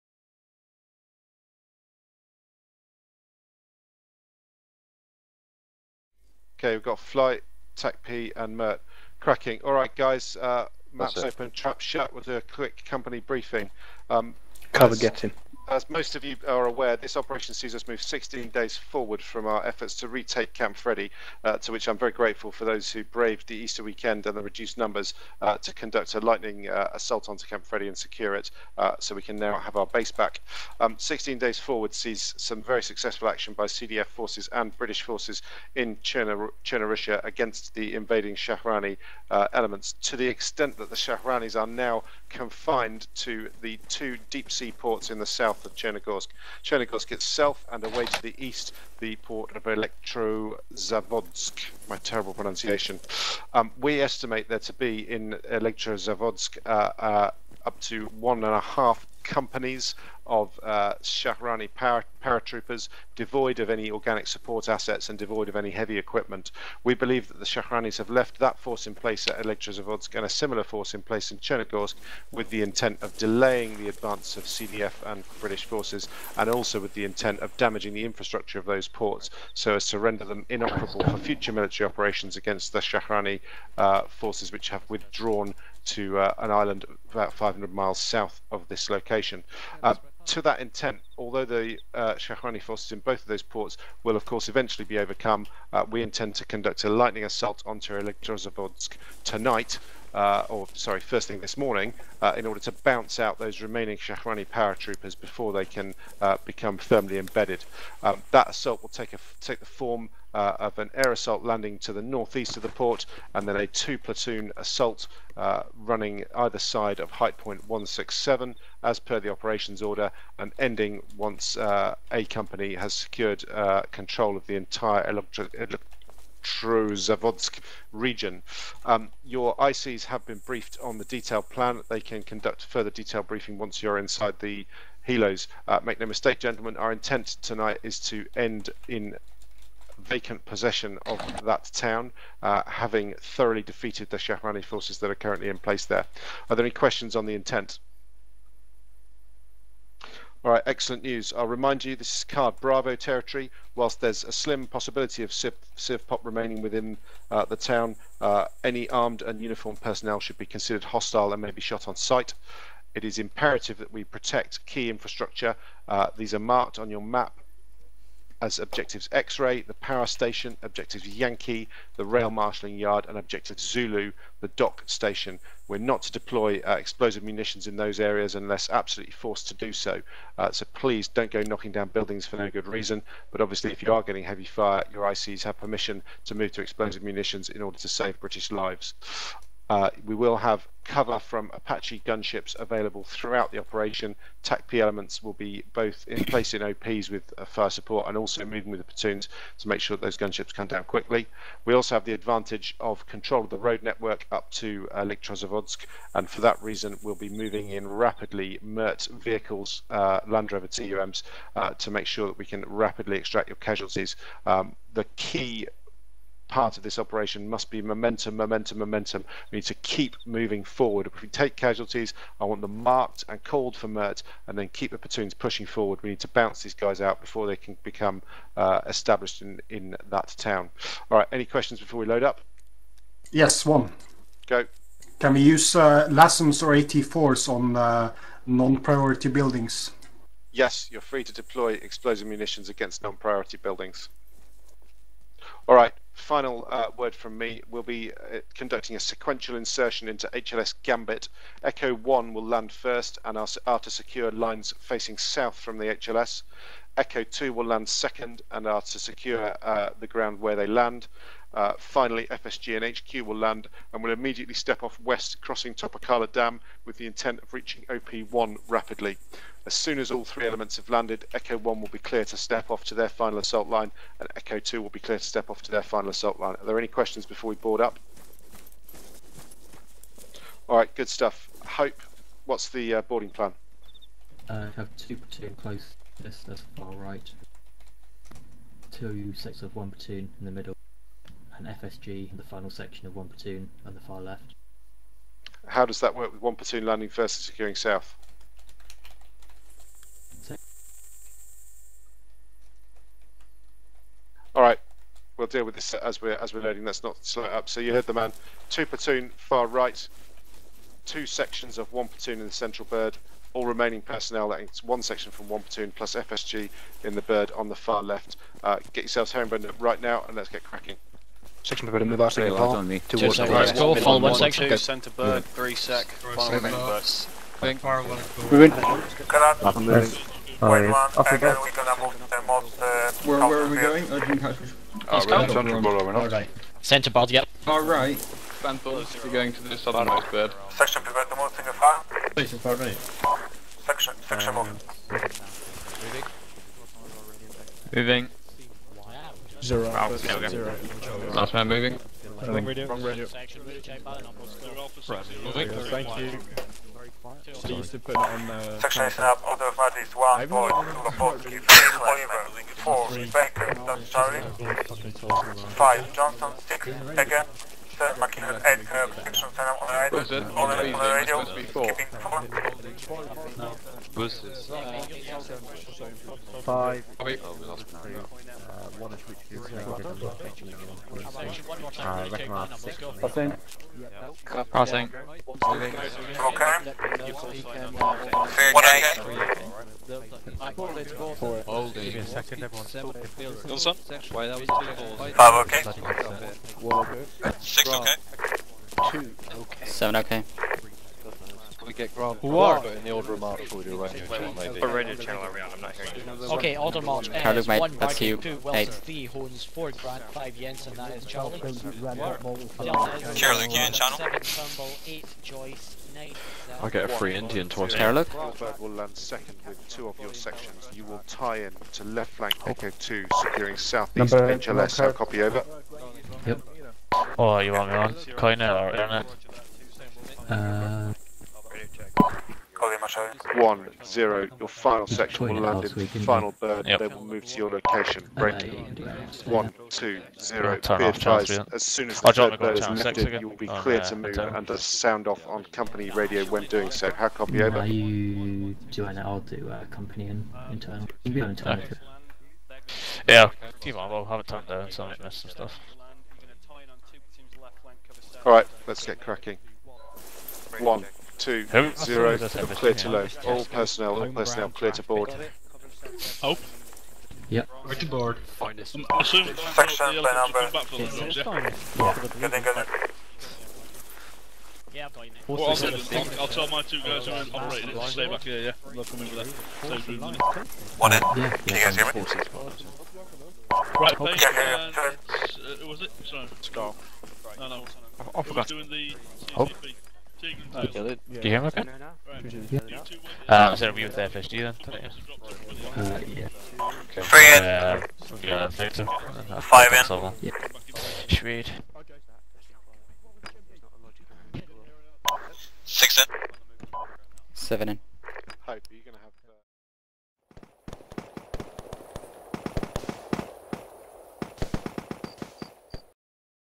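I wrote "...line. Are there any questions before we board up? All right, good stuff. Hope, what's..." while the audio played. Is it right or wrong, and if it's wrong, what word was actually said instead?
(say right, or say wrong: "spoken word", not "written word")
right.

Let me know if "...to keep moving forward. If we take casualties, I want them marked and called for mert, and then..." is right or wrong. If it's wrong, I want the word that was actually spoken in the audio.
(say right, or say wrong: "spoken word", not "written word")
right.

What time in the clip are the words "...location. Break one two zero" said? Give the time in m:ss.
7:17.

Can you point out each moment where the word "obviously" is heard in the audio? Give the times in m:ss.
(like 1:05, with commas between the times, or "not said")
3:03.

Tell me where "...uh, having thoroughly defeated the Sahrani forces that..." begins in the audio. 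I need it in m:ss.
2:22.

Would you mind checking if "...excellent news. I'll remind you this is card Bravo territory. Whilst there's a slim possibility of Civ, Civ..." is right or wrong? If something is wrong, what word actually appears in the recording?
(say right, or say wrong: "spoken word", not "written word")
right.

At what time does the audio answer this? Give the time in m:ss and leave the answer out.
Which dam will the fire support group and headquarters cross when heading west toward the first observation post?
4:25.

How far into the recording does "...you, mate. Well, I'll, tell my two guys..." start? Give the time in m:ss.
7:55.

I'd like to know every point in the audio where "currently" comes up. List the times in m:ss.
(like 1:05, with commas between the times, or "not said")
2:25.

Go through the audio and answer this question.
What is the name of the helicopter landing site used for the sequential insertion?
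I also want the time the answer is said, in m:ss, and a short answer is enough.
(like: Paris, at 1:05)
HLS Gambit, at 4:10.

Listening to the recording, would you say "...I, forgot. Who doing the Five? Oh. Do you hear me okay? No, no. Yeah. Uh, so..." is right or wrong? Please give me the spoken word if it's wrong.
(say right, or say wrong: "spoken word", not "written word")
wrong: "CCP", not "Five".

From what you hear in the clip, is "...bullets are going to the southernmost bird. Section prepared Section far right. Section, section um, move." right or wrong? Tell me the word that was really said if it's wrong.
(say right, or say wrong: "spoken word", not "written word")
right.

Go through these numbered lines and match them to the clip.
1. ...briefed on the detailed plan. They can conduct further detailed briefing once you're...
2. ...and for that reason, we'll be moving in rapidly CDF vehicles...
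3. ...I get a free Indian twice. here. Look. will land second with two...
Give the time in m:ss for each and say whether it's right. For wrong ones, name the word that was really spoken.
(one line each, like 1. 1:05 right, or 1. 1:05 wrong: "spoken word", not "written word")
1. 2:10 right
2. 3:26 wrong: "MERT", not "CDF"
3. 6:56 right.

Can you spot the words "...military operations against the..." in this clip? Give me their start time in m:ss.
1:21.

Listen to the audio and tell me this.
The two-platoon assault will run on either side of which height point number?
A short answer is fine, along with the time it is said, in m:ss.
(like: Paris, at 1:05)
167, at 1:57.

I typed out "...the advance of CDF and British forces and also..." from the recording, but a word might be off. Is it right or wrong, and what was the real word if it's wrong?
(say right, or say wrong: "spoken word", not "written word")
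right.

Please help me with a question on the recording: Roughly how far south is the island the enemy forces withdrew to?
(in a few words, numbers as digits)
500 miles.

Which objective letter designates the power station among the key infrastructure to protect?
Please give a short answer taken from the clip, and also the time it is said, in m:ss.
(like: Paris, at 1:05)
X-ray, at 2:49.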